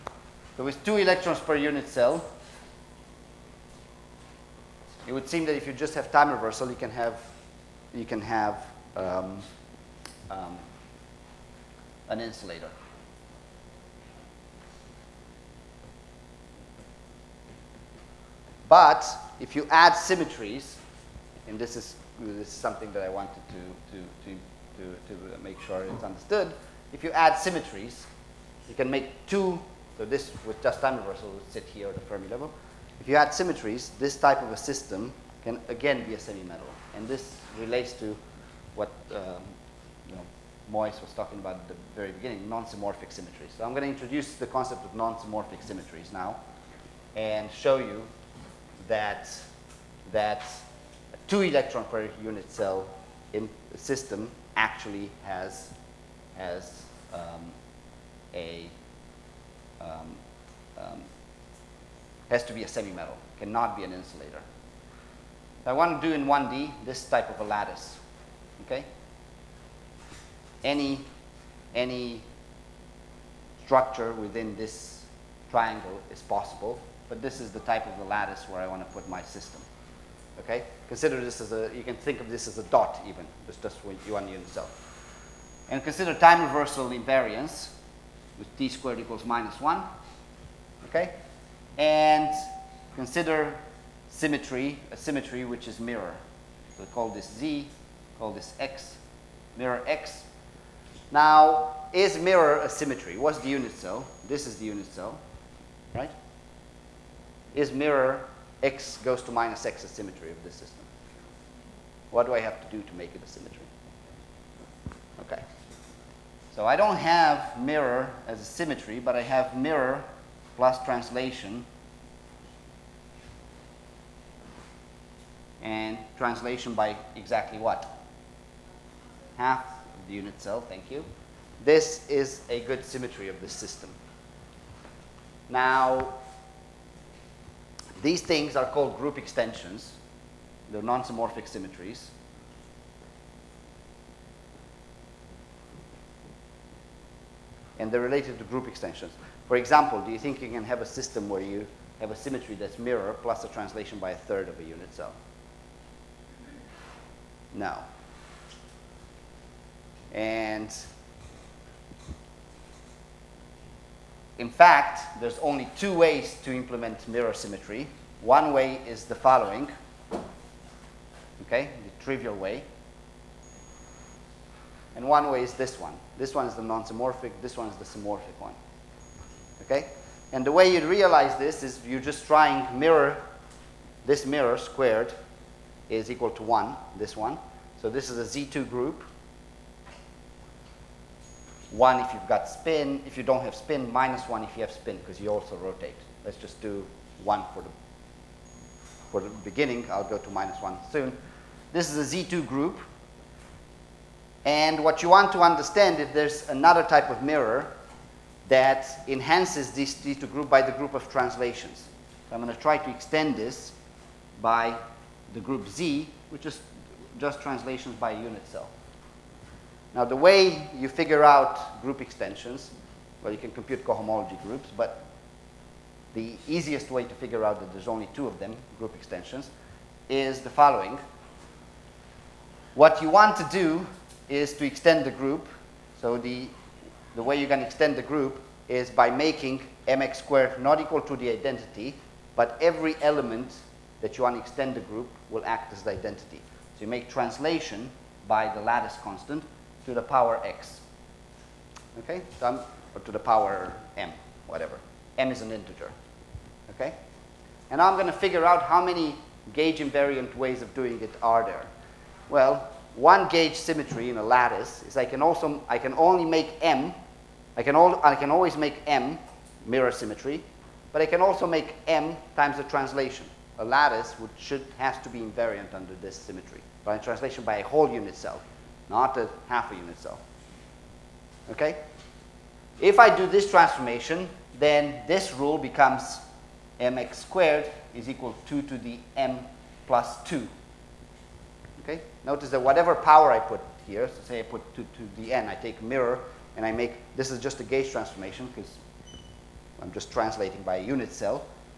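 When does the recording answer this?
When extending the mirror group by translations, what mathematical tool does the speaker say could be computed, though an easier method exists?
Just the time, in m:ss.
3:43.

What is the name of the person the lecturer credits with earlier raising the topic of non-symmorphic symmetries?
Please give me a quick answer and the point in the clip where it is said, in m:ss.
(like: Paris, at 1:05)
Moise, at 0:39.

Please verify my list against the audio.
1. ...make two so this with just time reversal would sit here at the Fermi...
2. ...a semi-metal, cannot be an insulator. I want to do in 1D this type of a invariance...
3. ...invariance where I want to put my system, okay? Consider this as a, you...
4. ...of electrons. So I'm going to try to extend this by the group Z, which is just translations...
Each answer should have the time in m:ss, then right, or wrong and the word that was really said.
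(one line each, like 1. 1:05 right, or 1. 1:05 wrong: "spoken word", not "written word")
1. 0:28 right
2. 1:02 wrong: "lattice", not "invariance"
3. 1:18 wrong: "lattice", not "invariance"
4. 3:30 wrong: "translations", not "electrons".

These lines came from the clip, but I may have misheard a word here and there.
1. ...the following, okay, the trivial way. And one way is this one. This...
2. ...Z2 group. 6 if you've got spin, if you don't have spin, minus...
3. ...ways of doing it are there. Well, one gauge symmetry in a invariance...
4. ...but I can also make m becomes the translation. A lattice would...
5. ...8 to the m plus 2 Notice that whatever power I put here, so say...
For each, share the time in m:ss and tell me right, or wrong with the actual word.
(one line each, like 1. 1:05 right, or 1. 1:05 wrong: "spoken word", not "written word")
1. 2:49 right
2. 3:08 wrong: "1", not "6"
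3. 4:20 wrong: "lattice", not "invariance"
4. 4:30 wrong: "times", not "becomes"
5. 4:48 wrong: "2", not "8".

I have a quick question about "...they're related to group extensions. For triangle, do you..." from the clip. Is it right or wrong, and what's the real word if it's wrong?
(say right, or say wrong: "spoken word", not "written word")
wrong: "example", not "triangle".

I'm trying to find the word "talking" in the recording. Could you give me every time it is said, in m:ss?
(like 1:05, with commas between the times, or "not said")
0:41.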